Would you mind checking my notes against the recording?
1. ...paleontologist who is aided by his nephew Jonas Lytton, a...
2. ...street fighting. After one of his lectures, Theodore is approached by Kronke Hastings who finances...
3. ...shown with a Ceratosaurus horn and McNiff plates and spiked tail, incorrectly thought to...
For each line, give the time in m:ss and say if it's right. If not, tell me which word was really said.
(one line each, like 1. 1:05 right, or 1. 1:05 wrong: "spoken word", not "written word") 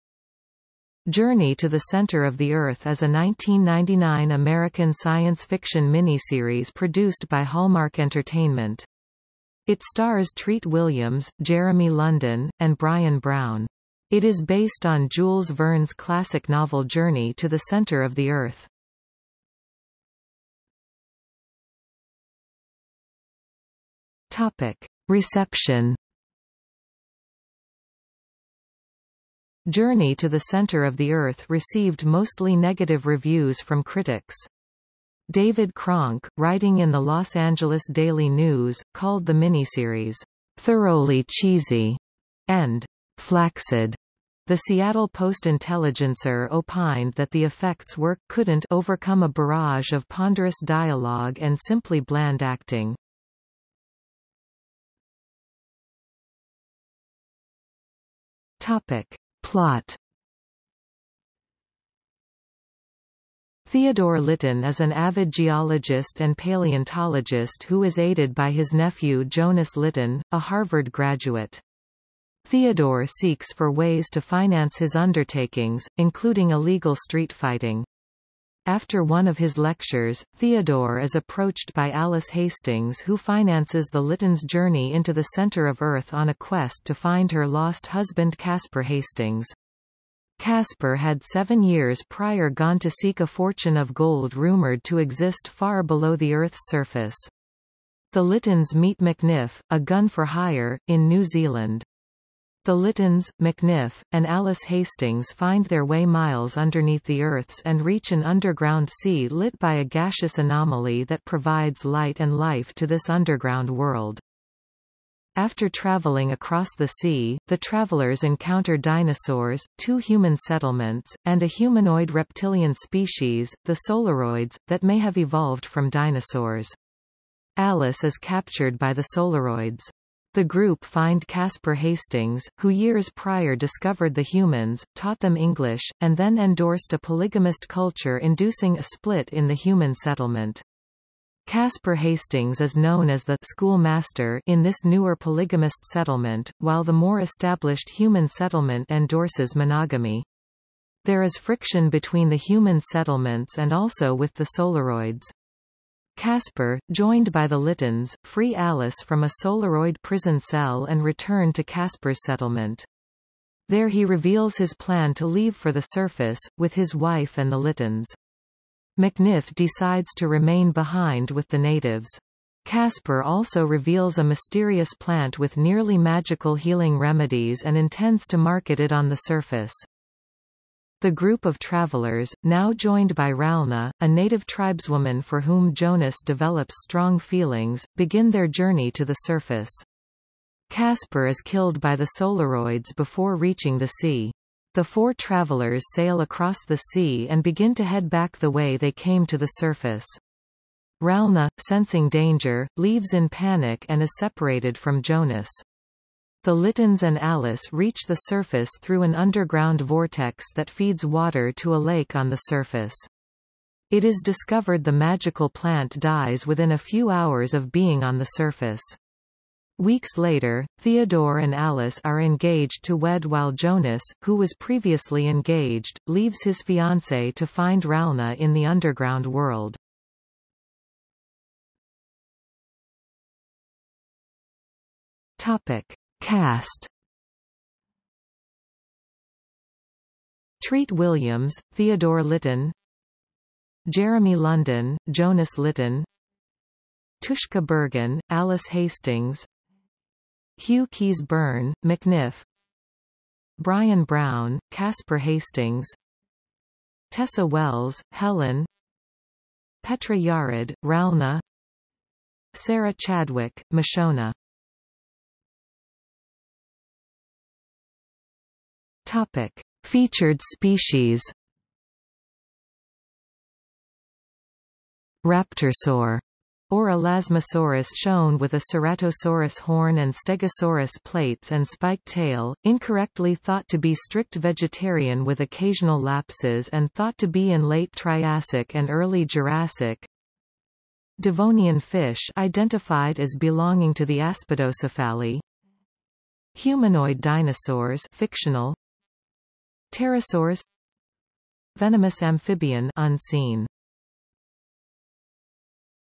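1. 1:06 right
2. 1:16 wrong: "Alice", not "Kronke"
3. 4:37 wrong: "Stegosaurus", not "McNiff".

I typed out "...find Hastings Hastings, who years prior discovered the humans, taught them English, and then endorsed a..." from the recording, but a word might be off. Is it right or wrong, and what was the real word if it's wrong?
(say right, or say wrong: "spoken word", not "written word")
wrong: "Casper", not "Hastings".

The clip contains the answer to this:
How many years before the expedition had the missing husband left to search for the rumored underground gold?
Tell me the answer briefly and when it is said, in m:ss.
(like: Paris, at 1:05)
7, at 1:31.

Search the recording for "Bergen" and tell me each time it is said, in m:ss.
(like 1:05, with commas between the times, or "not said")
4:07.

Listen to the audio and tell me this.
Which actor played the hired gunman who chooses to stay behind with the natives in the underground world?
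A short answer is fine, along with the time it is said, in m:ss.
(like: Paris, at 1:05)
Hugh Keays-Byrne, at 4:10.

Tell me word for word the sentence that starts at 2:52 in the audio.
Casper also reveals a mysterious plant with nearly magical healing remedies and intends to market it on the surface.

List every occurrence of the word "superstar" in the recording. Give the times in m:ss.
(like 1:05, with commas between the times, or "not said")
not said.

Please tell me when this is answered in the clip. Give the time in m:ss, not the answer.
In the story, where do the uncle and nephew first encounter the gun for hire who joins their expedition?
1:41.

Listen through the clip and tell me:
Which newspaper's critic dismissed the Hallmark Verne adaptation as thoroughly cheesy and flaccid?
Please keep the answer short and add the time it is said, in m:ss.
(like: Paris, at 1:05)
Los Angeles Daily News, at 0:36.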